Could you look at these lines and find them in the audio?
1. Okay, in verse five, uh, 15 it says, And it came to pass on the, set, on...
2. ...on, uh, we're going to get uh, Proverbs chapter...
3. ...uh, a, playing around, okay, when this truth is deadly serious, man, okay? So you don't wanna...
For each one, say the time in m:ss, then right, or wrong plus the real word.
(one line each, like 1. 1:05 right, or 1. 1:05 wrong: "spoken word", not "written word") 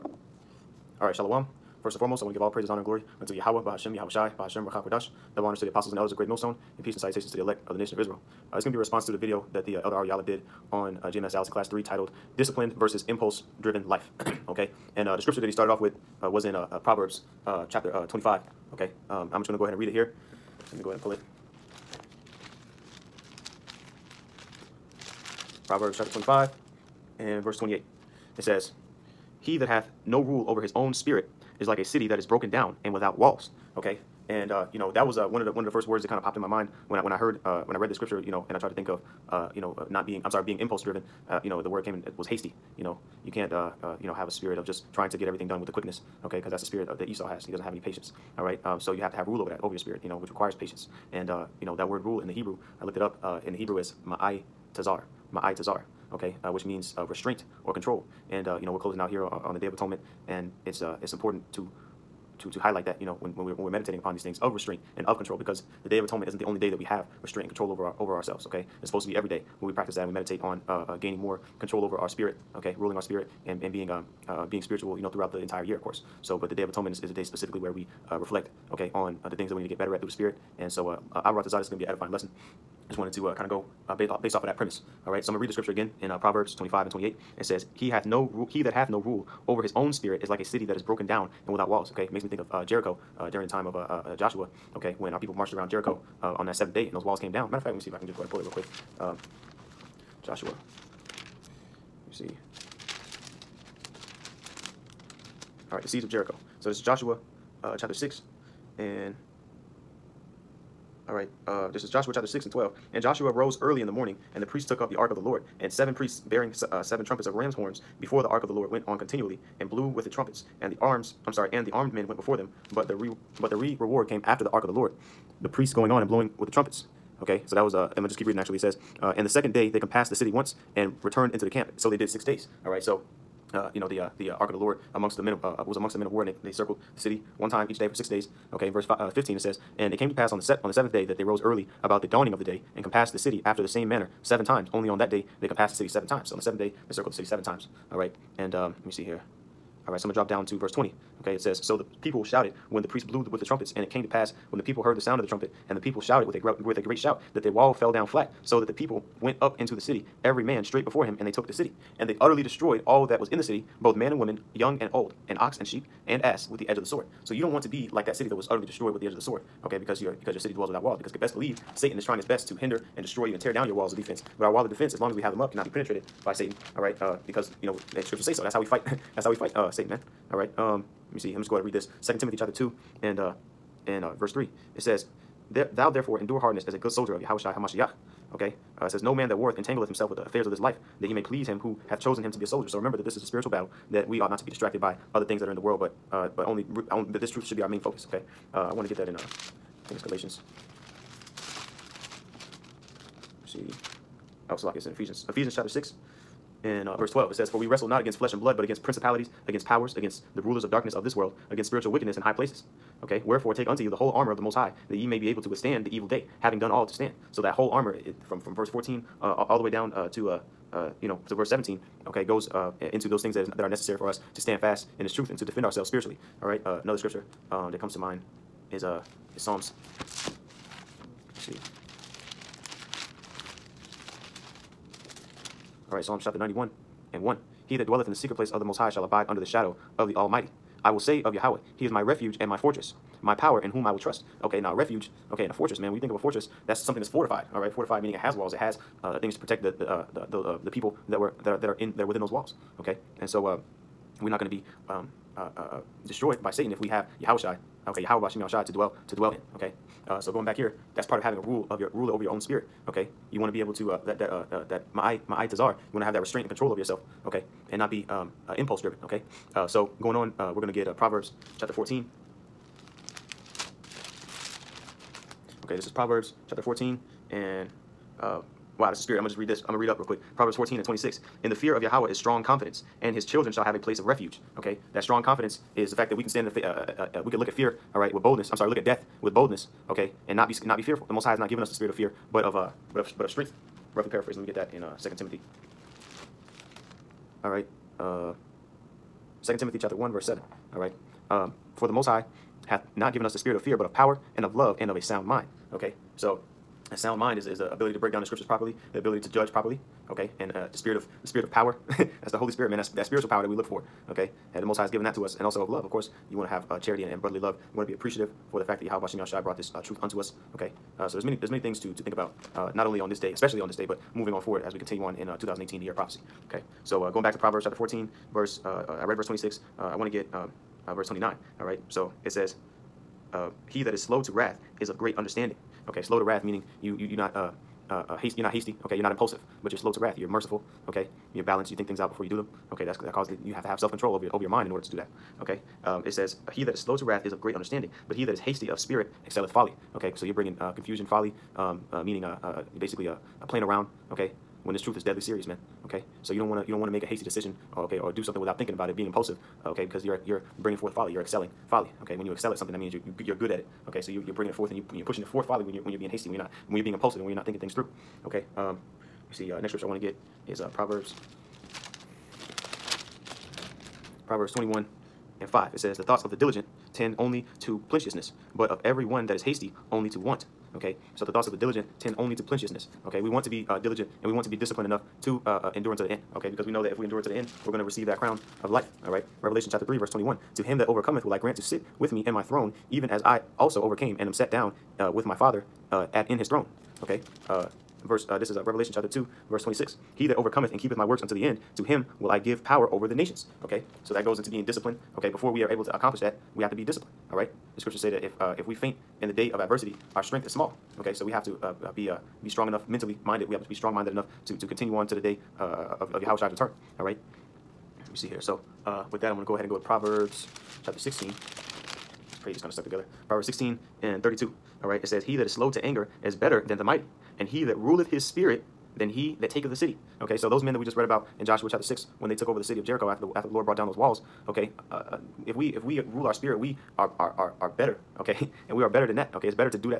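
1. 2:18 right
2. 4:30 right
3. 5:53 right.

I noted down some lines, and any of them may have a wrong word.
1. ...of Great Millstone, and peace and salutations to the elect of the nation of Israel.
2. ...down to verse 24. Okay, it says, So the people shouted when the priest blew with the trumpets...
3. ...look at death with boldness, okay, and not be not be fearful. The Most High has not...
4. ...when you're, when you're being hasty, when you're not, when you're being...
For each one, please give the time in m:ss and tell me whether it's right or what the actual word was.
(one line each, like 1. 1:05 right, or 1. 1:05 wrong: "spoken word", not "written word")
1. 0:06 right
2. 2:30 wrong: "20", not "24"
3. 4:48 right
4. 6:05 right.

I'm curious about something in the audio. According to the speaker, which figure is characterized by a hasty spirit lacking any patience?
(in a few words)
Esau.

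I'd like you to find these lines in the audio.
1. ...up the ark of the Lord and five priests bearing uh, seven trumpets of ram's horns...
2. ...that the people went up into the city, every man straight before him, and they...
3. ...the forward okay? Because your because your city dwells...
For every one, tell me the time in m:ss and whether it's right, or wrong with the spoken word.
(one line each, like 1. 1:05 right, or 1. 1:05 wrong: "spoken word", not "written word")
1. 1:54 wrong: "seven", not "five"
2. 2:38 right
3. 2:49 wrong: "sword", not "forward".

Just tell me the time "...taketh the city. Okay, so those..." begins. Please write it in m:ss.
7:09.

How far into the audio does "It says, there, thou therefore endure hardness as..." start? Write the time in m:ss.
3:04.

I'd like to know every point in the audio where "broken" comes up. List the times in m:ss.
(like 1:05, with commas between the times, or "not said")
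0:32, 1:30.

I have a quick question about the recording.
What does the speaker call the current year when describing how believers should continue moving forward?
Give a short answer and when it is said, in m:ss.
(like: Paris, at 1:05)
the year of prophecy, at 5:25.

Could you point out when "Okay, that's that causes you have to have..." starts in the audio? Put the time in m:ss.
5:42.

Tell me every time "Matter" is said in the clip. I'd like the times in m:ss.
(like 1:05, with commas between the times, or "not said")
1:37.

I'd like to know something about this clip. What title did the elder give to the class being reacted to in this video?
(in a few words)
Disciplined versus Impulse Driven Life.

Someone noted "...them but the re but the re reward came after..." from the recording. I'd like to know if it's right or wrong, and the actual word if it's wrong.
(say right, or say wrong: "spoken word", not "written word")
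right.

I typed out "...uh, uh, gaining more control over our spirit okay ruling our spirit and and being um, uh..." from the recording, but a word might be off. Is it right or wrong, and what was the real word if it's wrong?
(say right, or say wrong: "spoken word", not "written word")
right.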